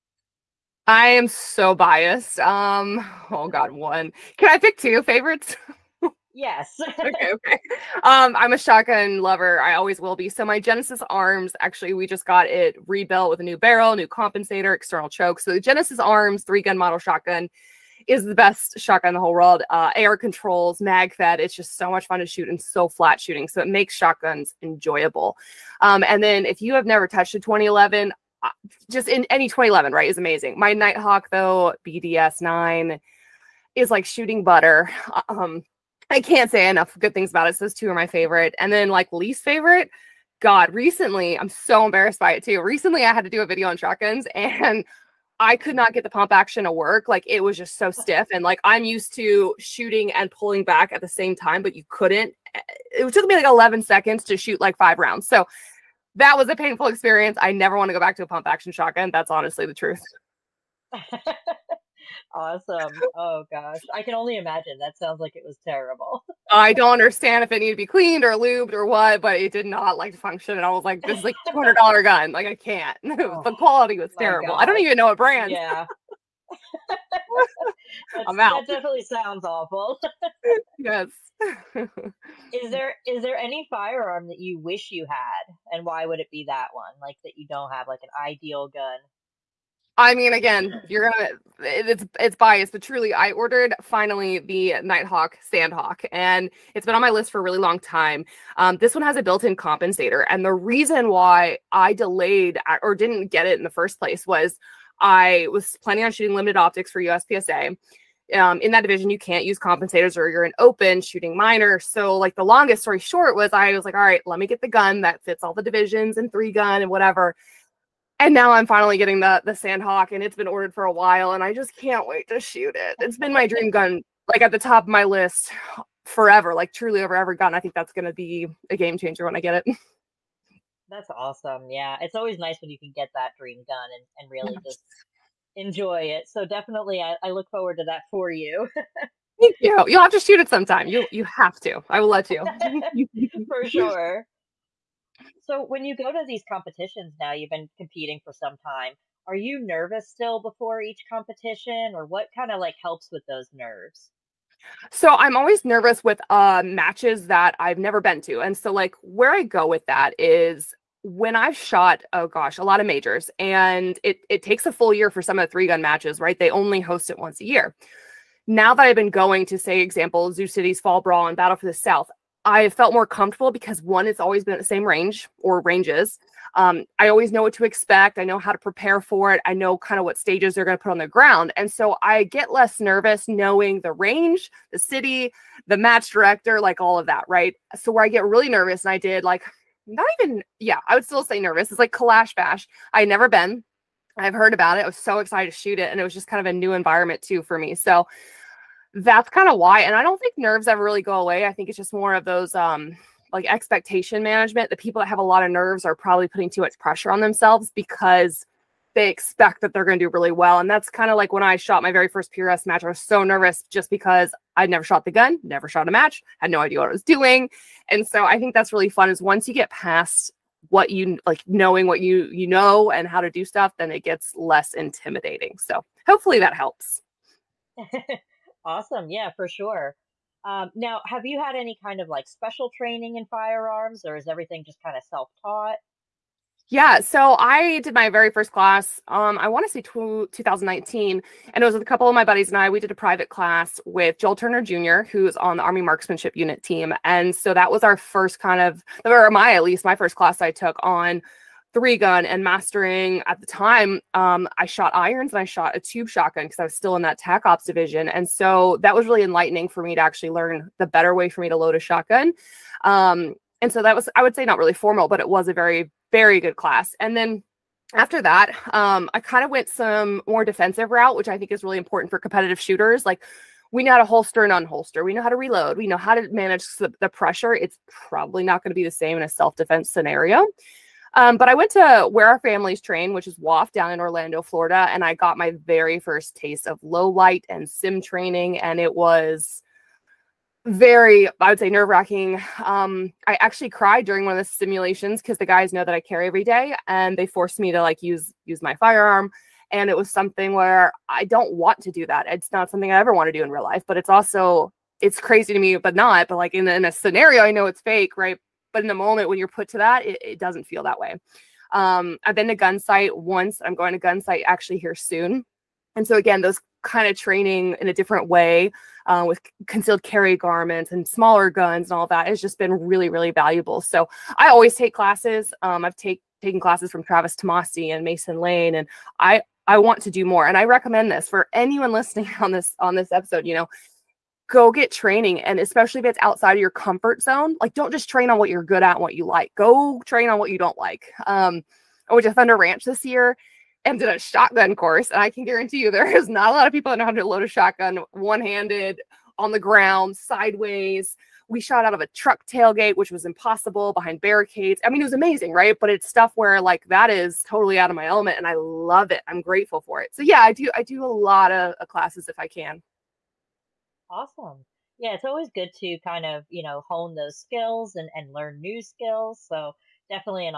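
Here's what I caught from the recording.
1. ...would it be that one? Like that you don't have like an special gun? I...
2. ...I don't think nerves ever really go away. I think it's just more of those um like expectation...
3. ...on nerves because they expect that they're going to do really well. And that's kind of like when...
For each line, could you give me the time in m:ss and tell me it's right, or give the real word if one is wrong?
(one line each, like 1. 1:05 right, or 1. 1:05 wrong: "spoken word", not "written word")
1. 1:26 wrong: "ideal", not "special"
2. 3:19 right
3. 3:27 wrong: "themselves", not "nerves".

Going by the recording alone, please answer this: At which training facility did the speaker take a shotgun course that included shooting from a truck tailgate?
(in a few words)
Thunder Ranch.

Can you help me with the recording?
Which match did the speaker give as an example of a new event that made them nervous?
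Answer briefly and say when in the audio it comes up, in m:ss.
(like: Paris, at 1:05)
Kalash Bash, at 3:11.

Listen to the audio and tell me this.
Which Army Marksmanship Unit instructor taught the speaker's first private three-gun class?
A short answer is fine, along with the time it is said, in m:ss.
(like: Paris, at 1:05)
Joel Turner Jr., at 4:04.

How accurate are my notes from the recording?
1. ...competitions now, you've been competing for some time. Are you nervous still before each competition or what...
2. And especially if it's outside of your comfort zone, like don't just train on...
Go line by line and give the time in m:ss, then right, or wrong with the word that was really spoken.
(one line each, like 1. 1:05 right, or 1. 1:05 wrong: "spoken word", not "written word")
1. 2:26 right
2. 5:35 right.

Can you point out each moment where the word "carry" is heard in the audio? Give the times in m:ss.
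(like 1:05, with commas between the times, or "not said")
4:56, 5:20.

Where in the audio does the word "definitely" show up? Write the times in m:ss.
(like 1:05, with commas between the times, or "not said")
1:18, 2:16.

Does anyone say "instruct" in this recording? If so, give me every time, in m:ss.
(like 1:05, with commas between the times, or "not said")
not said.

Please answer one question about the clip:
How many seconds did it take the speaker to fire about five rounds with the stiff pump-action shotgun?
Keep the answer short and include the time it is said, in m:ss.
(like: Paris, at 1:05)
11, at 0:53.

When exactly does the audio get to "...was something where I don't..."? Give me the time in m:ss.
4:59.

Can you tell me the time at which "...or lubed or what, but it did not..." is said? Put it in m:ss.
1:08.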